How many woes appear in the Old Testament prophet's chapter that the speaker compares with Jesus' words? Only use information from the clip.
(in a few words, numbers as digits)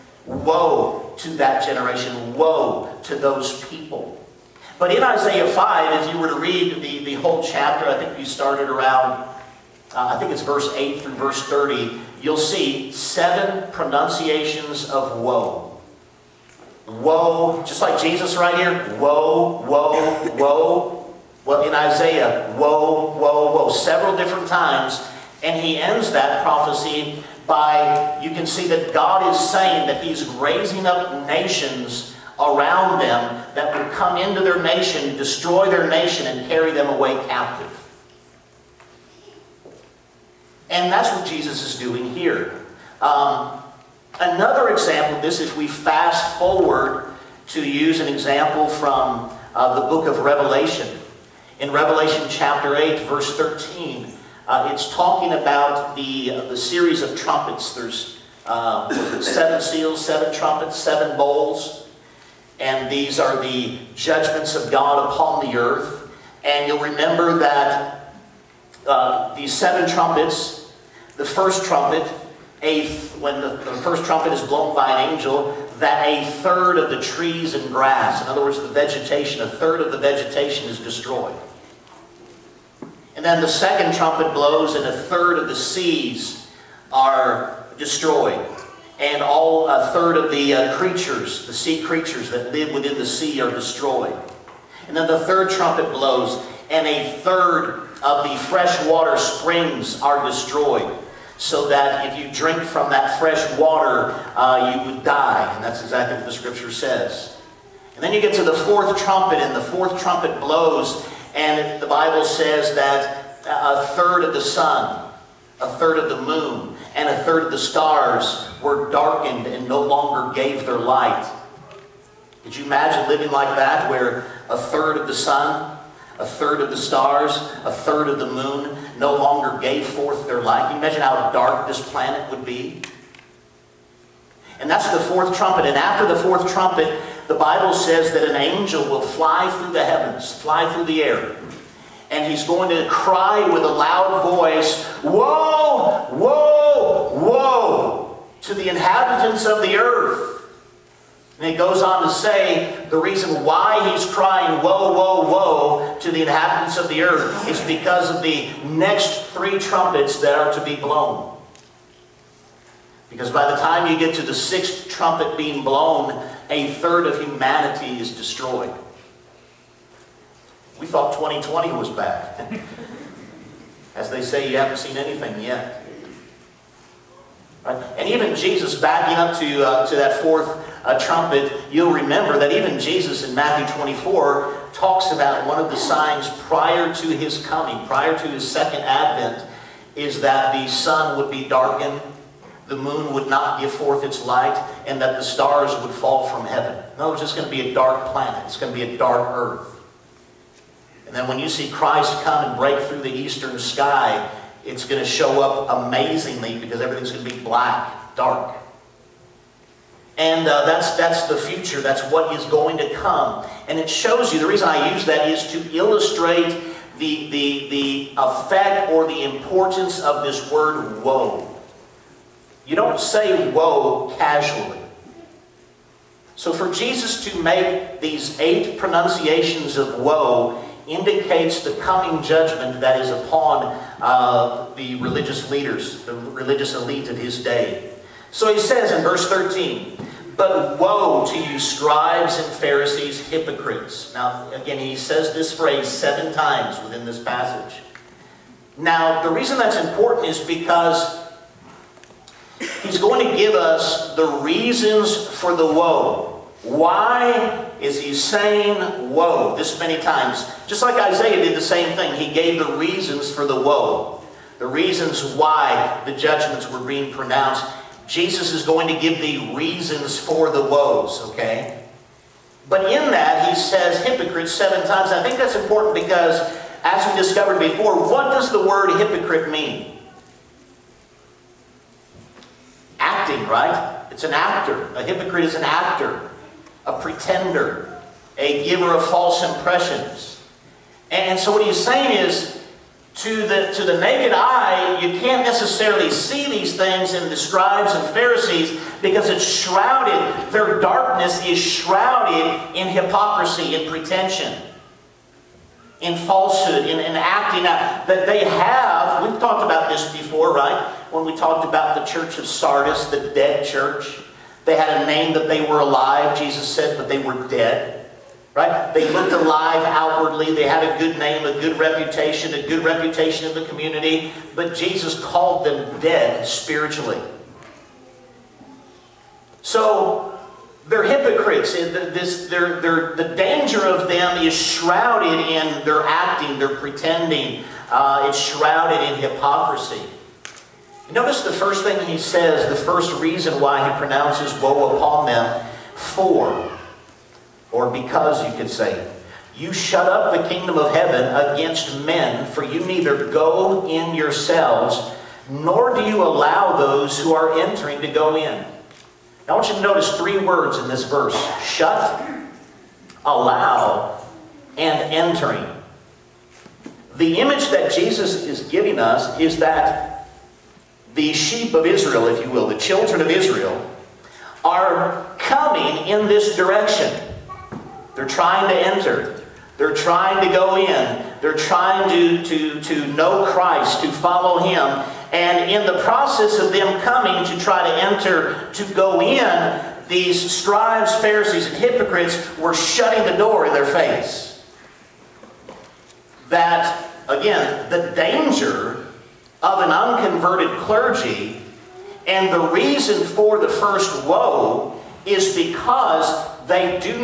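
7.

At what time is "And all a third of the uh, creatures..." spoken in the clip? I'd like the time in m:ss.
1:28.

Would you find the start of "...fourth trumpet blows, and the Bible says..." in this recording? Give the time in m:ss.
1:49.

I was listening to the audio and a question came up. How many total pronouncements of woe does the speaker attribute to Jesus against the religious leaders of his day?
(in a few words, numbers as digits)
8.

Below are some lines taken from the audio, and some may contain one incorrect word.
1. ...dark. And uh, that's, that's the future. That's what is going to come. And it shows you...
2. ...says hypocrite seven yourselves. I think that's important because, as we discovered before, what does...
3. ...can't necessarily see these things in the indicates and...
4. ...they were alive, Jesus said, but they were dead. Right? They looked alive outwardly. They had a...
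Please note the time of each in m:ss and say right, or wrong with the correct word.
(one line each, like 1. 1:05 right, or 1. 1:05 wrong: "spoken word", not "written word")
1. 3:28 right
2. 4:33 wrong: "times", not "yourselves"
3. 4:55 wrong: "scribes", not "indicates"
4. 5:15 right.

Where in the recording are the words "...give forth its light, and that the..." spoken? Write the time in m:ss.
3:13.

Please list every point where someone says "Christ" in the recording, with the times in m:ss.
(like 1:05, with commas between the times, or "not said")
3:21, 6:23.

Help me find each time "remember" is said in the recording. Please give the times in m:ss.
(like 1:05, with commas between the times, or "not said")
1:06, 3:01.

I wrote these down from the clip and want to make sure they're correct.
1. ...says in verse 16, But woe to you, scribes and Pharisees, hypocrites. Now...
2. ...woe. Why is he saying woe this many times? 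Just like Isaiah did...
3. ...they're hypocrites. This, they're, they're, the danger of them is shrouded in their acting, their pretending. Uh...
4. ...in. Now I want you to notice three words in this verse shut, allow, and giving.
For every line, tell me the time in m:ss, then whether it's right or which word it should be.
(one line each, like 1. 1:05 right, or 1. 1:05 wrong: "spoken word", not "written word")
1. 3:58 wrong: "13", not "16"
2. 4:15 right
3. 5:30 right
4. 5:58 wrong: "entering", not "giving".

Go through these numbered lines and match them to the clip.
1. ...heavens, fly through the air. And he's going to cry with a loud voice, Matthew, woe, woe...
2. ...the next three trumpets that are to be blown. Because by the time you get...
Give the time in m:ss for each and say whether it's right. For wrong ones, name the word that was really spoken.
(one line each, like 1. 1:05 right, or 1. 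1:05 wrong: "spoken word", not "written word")
1. 2:19 wrong: "Woe", not "Matthew"
2. 2:38 right.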